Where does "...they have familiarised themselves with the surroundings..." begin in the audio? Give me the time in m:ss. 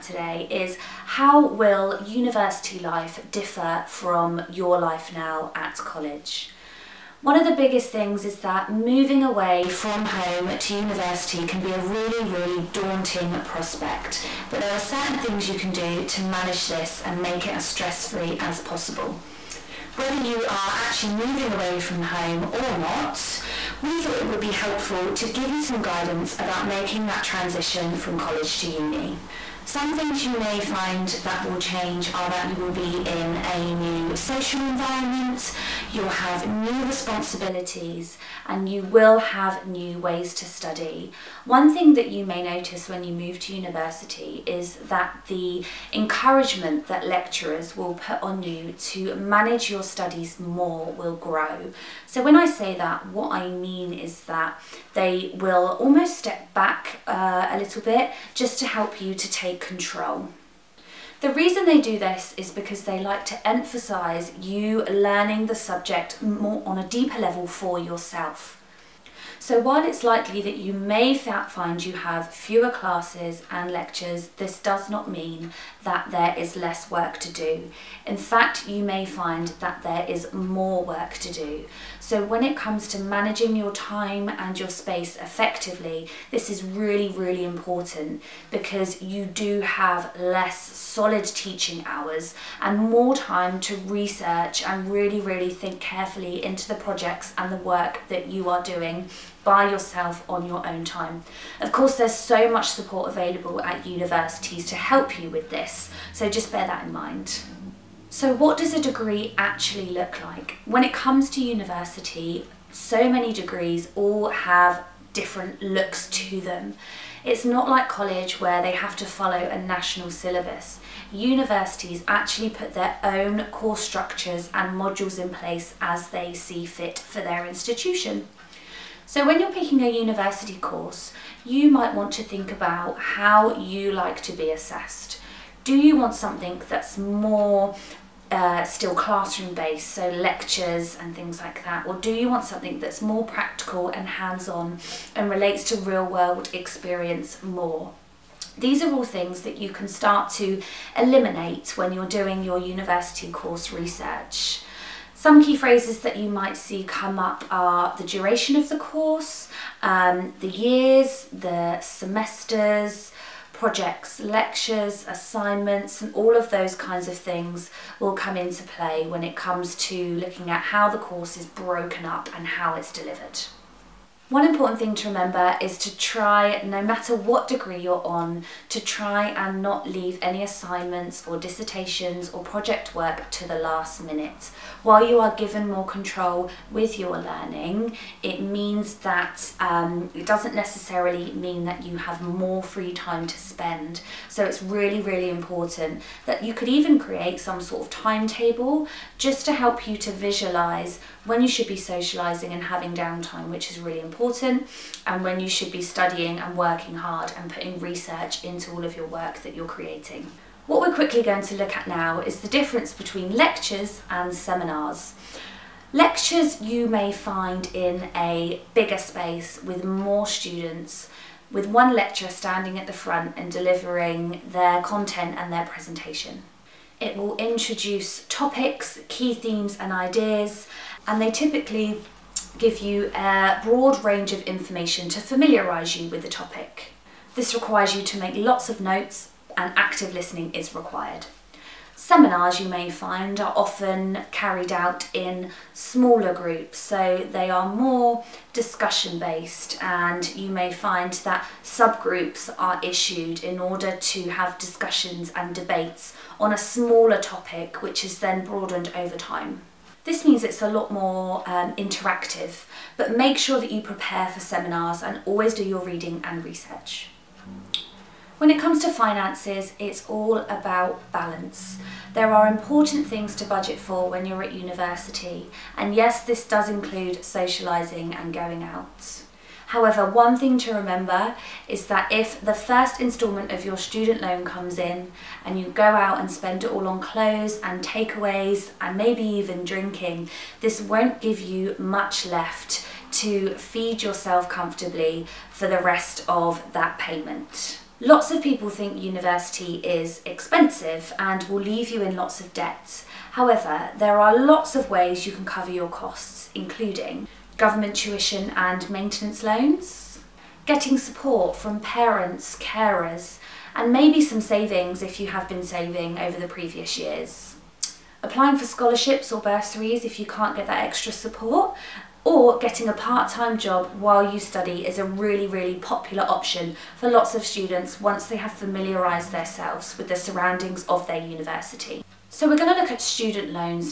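5:28.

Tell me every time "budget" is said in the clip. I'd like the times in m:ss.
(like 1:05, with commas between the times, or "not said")
4:33.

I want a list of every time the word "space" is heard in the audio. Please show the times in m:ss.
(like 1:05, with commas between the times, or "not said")
1:24, 3:38.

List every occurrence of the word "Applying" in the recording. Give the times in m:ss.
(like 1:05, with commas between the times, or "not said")
5:18.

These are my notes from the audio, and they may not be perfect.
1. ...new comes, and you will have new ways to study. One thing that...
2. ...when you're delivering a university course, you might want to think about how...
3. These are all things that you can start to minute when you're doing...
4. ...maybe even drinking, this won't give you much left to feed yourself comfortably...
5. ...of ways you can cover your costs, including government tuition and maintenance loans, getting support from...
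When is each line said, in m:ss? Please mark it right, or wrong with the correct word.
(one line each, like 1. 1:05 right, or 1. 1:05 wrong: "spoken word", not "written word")
1. 0:36 wrong: "responsibilities", not "comes"
2. 2:09 wrong: "picking", not "delivering"
3. 2:28 wrong: "eliminate", not "minute"
4. 4:48 right
5. 5:04 right.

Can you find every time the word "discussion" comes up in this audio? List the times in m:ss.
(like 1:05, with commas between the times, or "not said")
4:08, 4:14.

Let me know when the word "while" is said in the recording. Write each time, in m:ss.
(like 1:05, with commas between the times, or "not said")
1:09, 3:04, 5:23.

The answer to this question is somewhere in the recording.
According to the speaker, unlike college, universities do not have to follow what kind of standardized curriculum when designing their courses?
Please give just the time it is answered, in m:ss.
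1:59.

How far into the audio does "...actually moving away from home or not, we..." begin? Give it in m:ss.
0:20.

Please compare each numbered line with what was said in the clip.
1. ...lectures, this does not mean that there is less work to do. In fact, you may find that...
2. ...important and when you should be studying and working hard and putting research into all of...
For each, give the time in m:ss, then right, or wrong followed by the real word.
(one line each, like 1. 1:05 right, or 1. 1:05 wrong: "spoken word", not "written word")
1. 1:13 right
2. 3:24 right.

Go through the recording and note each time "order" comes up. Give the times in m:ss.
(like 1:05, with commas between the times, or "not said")
4:13.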